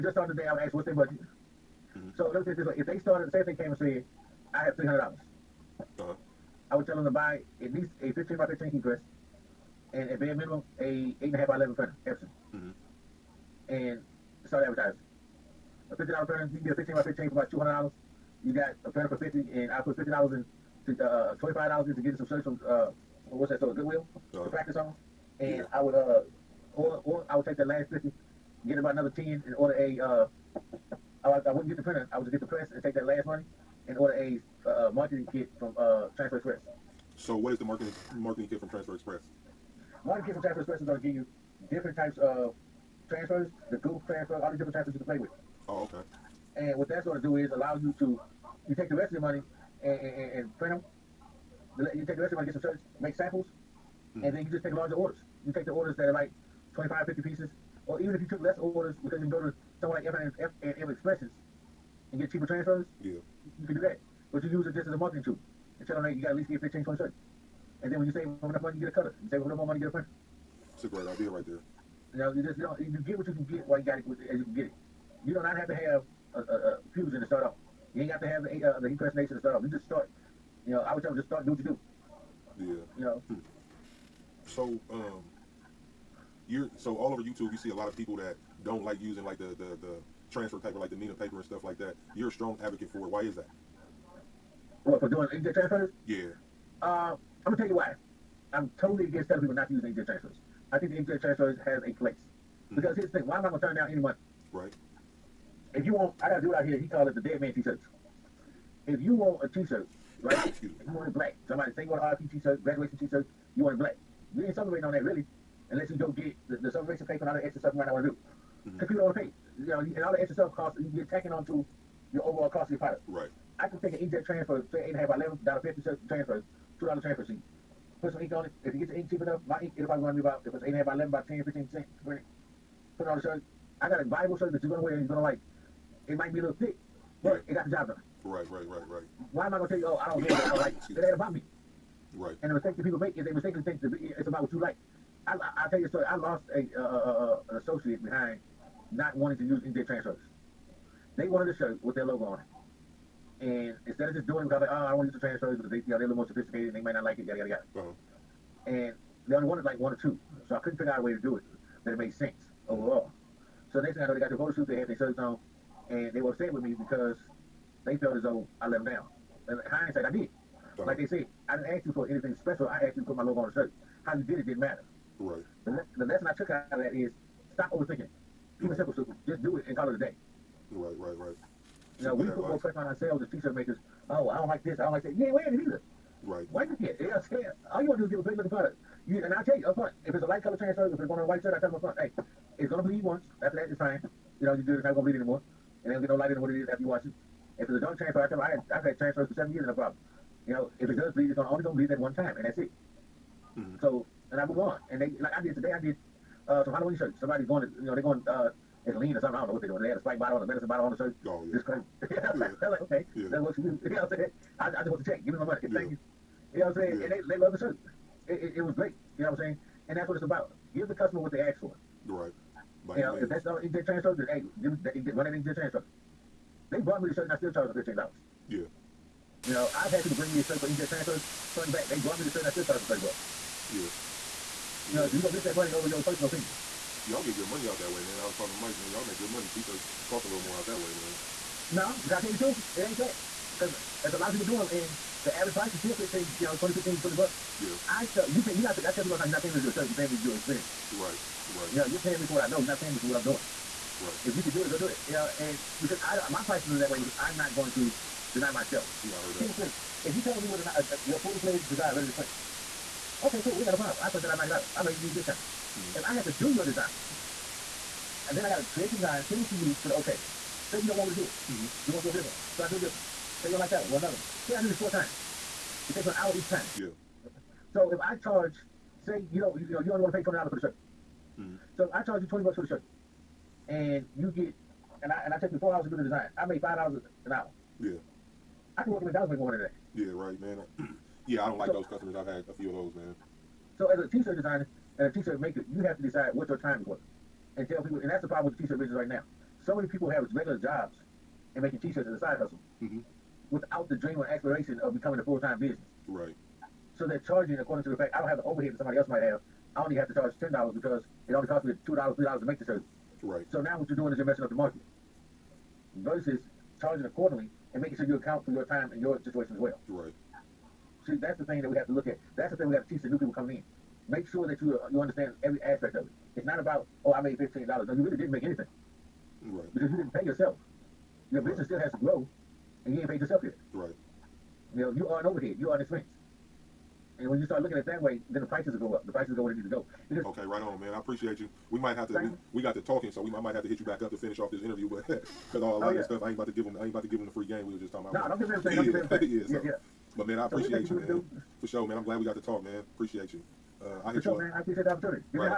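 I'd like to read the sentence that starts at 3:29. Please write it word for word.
They had a Sprite bottle and a medicine bottle on the shirt.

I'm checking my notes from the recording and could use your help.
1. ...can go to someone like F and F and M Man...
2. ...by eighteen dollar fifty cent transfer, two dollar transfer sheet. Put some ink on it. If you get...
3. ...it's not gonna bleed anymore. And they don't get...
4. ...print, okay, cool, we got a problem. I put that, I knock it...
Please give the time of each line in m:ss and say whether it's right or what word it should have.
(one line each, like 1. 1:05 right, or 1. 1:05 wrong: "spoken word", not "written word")
1. 0:59 wrong: "Expressions", not "Man"
2. 2:05 wrong: "eleven", not "eighteen"
3. 3:14 right
4. 4:22 right.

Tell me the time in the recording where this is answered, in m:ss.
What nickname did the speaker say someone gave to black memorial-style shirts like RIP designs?
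1:47.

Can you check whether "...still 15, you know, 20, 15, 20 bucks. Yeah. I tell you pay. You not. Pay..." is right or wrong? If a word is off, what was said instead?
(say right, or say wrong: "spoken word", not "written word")
right.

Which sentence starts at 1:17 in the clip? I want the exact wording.
You ain't got to have the uh, the impersonation to start off.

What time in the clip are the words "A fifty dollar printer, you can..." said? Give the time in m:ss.
0:15.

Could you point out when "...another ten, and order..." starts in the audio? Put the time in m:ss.
0:28.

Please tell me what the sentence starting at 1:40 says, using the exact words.
I think the AJ transfers has a place.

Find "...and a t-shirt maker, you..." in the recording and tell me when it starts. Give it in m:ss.
4:54.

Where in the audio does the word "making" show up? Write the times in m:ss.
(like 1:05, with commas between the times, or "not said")
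5:01, 5:17.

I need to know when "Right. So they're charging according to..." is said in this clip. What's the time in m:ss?
5:06.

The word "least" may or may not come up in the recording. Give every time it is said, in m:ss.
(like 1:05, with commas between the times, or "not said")
0:07, 1:06.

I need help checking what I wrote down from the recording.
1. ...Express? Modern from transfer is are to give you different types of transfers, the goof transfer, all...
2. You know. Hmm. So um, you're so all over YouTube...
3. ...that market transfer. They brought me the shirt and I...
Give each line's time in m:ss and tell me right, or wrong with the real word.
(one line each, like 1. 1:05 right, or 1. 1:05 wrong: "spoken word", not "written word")
1. 0:38 right
2. 1:22 right
3. 3:45 wrong: "inkjet", not "market".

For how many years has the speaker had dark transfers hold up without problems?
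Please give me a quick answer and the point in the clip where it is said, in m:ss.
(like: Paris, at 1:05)
7, at 3:19.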